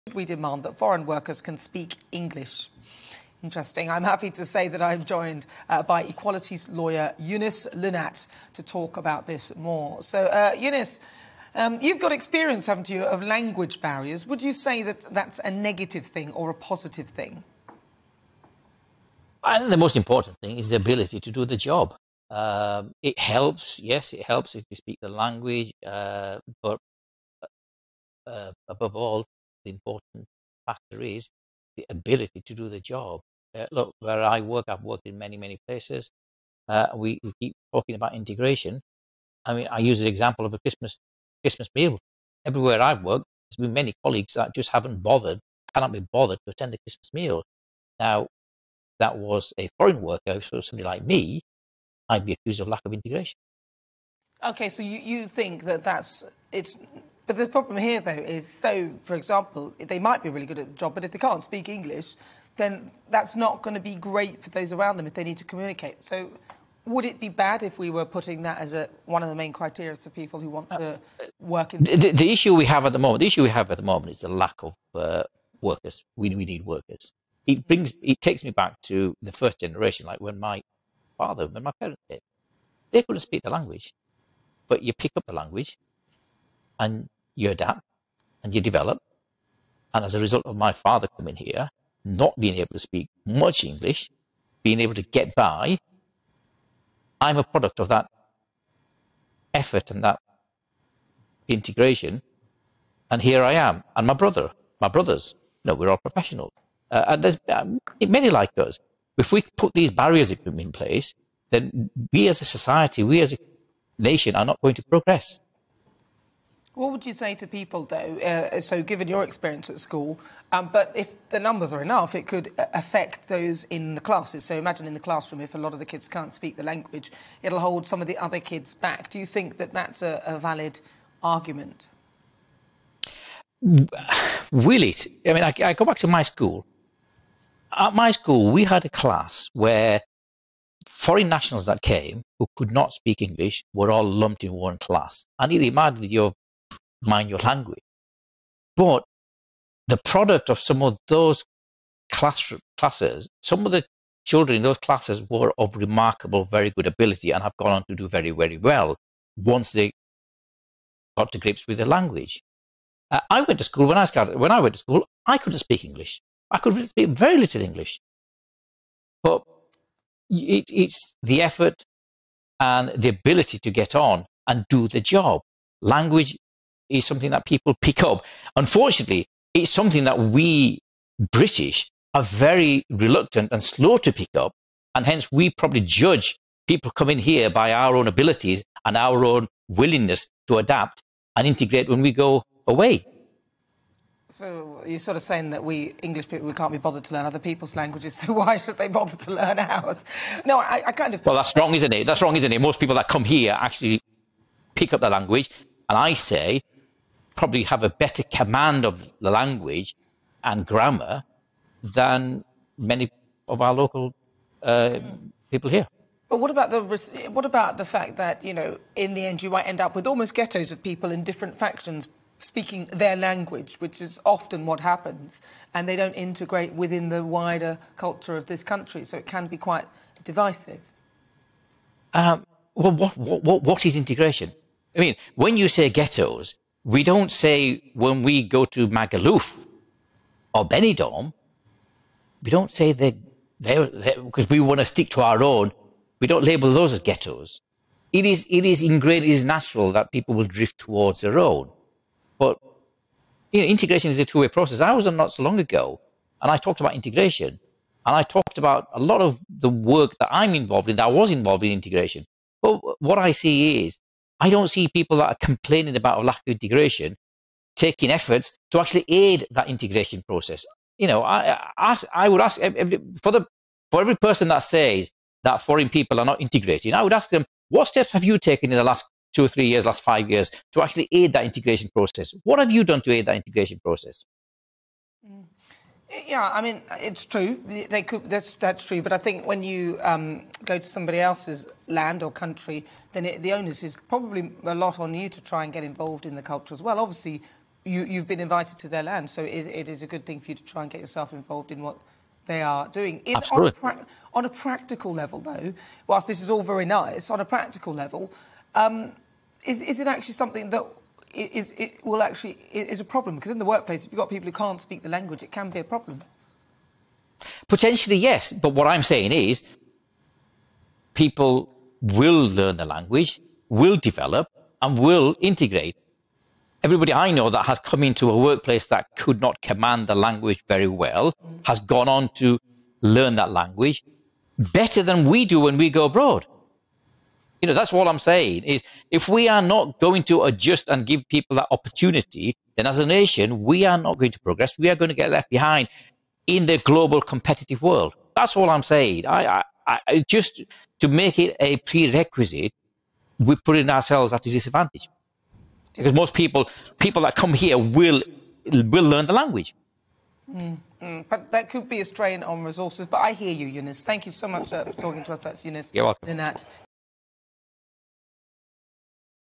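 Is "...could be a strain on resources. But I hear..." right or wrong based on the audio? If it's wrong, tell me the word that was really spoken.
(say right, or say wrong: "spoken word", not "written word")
right.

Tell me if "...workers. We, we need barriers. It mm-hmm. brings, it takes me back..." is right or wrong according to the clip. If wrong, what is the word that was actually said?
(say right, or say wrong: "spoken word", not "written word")
wrong: "workers", not "barriers".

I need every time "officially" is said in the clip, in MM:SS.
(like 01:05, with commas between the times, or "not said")
not said.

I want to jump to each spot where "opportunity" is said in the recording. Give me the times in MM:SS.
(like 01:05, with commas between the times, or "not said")
05:41.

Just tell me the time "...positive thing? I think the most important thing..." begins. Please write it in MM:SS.
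00:16.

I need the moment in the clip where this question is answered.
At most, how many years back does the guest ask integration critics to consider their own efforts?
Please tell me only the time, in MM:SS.
04:40.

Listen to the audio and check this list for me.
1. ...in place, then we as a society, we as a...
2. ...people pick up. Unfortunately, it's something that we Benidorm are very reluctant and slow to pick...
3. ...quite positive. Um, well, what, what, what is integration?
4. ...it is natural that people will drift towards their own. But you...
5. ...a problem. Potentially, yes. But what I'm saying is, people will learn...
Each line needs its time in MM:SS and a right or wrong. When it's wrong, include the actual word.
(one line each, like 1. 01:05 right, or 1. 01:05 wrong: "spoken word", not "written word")
1. 01:50 right
2. 02:57 wrong: "British", not "Benidorm"
3. 03:49 wrong: "divisive", not "positive"
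4. 04:09 right
5. 05:15 right.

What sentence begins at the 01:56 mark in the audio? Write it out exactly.
What would you say to people, though?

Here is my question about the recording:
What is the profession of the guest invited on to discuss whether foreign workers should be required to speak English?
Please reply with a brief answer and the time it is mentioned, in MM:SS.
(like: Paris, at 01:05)
Equalities lawyer, at 00:06.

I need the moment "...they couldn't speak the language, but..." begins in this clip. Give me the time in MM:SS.
01:22.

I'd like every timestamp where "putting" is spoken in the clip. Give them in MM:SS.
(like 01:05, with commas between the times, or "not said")
01:08, 05:53.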